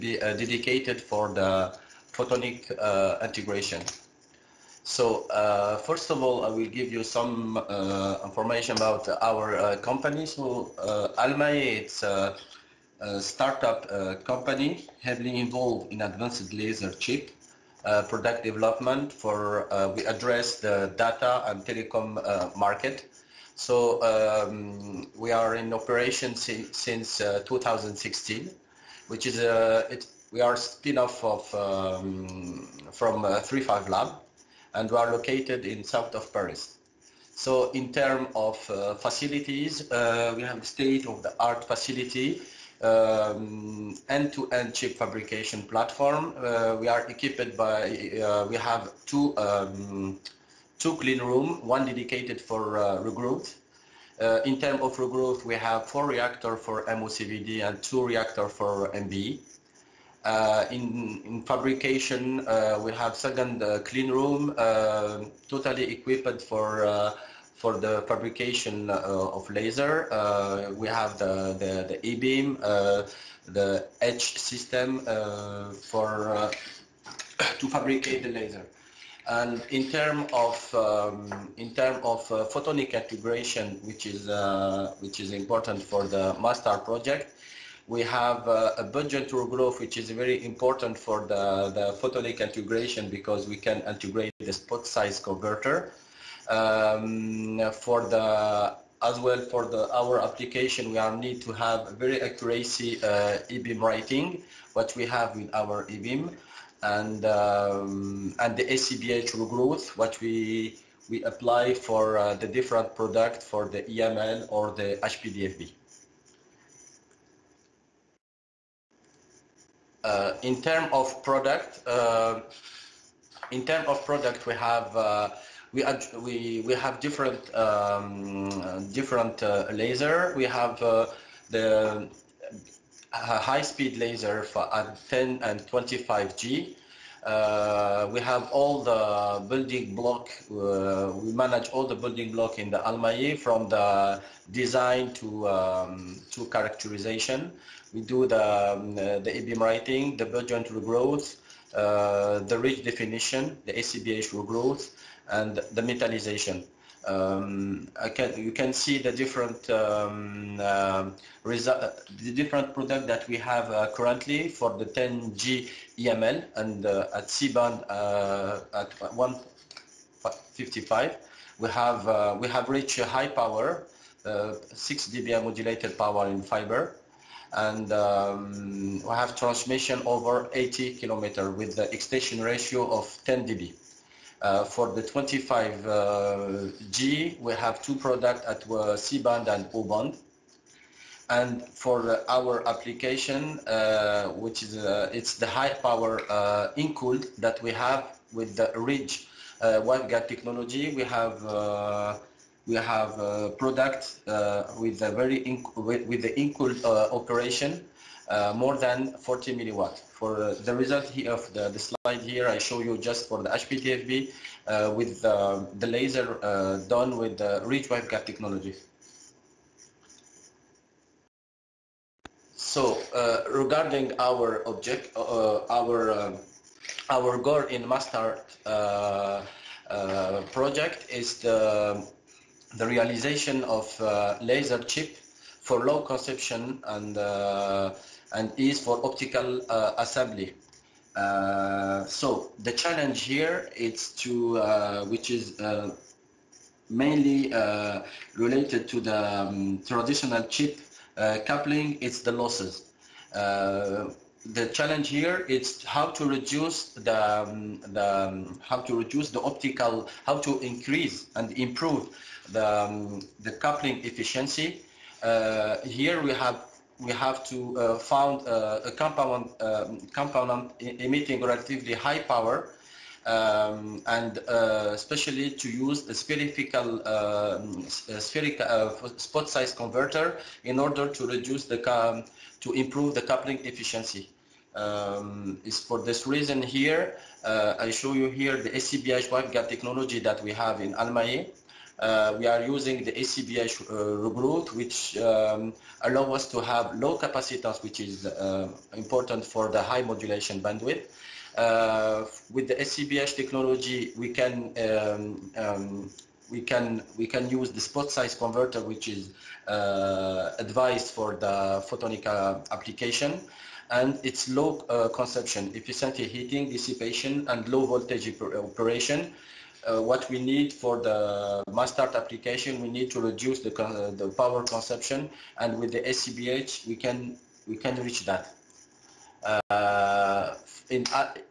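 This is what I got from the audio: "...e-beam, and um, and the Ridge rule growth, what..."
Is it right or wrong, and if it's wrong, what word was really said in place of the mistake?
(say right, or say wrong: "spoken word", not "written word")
wrong: "ACBH", not "Ridge".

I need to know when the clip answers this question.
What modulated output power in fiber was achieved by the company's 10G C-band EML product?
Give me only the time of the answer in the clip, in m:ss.
2:54.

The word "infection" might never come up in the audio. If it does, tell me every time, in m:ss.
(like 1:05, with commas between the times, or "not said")
not said.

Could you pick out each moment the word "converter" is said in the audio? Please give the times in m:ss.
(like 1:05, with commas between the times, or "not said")
1:35, 4:39, 5:08.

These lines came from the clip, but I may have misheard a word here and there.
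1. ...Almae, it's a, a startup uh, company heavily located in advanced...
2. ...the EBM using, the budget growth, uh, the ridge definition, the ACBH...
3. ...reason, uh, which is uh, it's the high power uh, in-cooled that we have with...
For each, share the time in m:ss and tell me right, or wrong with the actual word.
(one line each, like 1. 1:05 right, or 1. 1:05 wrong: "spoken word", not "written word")
1. 0:11 wrong: "involved", not "located"
2. 2:29 wrong: "writing", not "using"
3. 3:12 wrong: "application", not "reason".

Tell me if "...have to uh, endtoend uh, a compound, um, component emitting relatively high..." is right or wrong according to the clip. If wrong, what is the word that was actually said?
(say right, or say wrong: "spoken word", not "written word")
wrong: "found", not "endtoend".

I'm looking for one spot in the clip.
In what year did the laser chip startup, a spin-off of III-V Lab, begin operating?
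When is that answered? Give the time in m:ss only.
0:27.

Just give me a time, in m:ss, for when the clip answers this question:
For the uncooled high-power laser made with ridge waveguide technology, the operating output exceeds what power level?
3:29.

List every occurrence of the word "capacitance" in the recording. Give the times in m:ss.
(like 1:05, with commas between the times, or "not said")
4:57.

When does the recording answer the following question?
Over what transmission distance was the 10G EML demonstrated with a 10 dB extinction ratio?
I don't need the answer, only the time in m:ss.
3:00.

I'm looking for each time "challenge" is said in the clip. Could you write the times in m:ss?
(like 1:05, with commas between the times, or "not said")
4:02, 4:14.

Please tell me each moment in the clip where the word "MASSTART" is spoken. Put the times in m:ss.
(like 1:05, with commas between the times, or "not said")
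1:26, 3:47, 5:21.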